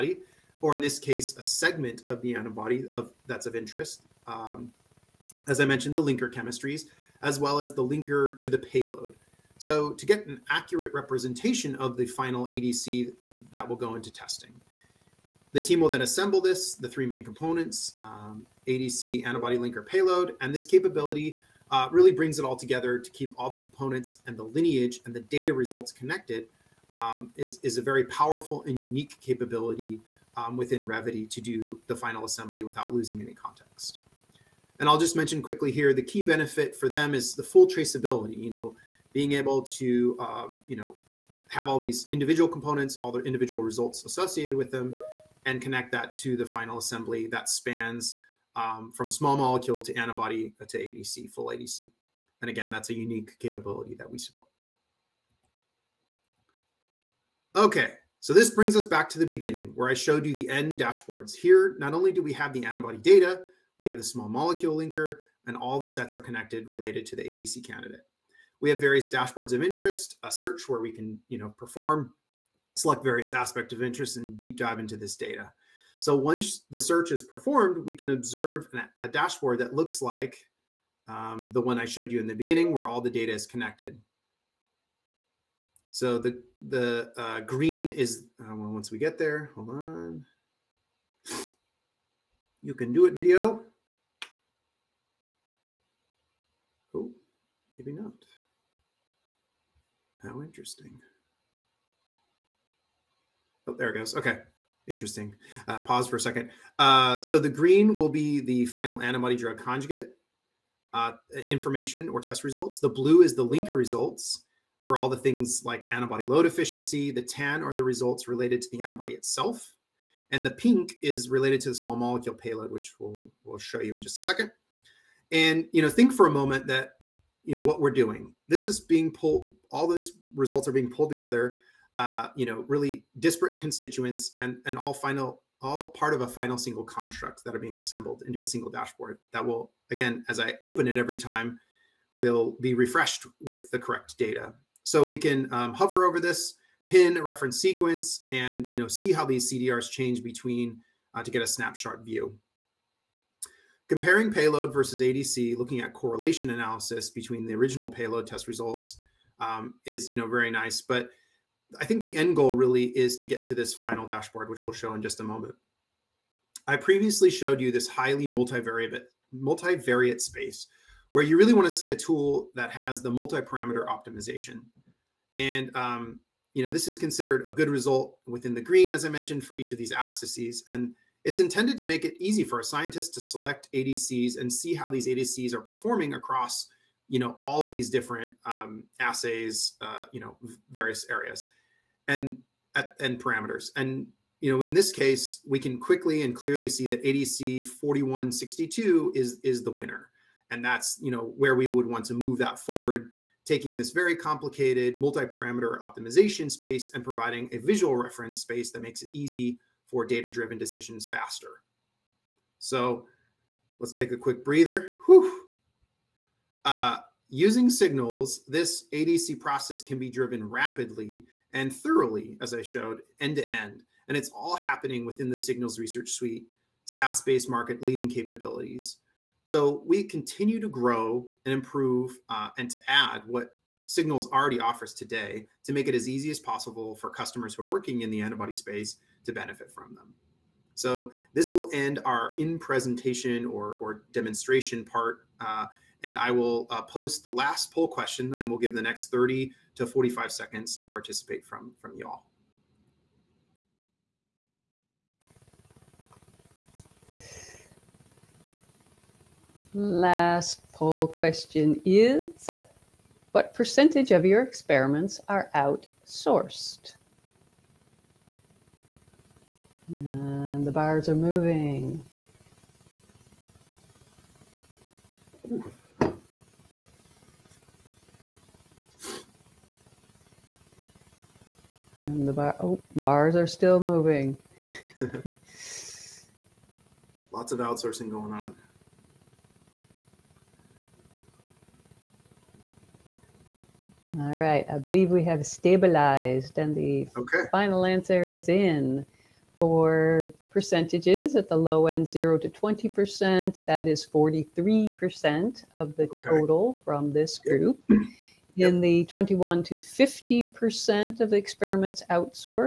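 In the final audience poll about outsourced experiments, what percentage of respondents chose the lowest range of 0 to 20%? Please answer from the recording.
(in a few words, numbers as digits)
43%.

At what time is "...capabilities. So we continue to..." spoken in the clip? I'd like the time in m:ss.
3:48.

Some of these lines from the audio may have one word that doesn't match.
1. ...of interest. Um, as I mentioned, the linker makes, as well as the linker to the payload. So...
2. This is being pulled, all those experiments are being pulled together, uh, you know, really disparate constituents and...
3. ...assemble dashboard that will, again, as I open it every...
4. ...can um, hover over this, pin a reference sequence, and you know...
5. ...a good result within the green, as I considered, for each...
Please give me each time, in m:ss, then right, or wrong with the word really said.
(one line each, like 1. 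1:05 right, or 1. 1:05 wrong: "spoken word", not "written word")
1. 0:03 wrong: "chemistries", not "makes"
2. 2:08 wrong: "results", not "experiments"
3. 2:18 wrong: "single", not "assemble"
4. 2:25 right
5. 2:57 wrong: "mentioned", not "considered".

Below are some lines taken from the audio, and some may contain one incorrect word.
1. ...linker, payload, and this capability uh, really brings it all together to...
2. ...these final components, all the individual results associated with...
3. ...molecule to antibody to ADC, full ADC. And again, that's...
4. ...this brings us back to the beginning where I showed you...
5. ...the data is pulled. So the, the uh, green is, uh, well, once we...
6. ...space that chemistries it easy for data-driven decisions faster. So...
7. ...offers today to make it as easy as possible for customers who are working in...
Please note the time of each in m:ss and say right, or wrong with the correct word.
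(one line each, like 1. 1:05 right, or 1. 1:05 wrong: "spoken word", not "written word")
1. 0:19 right
2. 0:41 wrong: "individual", not "final"
3. 0:49 right
4. 0:58 right
5. 1:22 wrong: "connected", not "pulled"
6. 3:28 wrong: "makes", not "chemistries"
7. 3:54 right.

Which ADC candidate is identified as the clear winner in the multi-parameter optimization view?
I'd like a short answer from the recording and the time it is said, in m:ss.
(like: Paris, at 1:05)
ADC 4162, at 3:17.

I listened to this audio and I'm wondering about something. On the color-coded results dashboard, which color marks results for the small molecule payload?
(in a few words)
Pink.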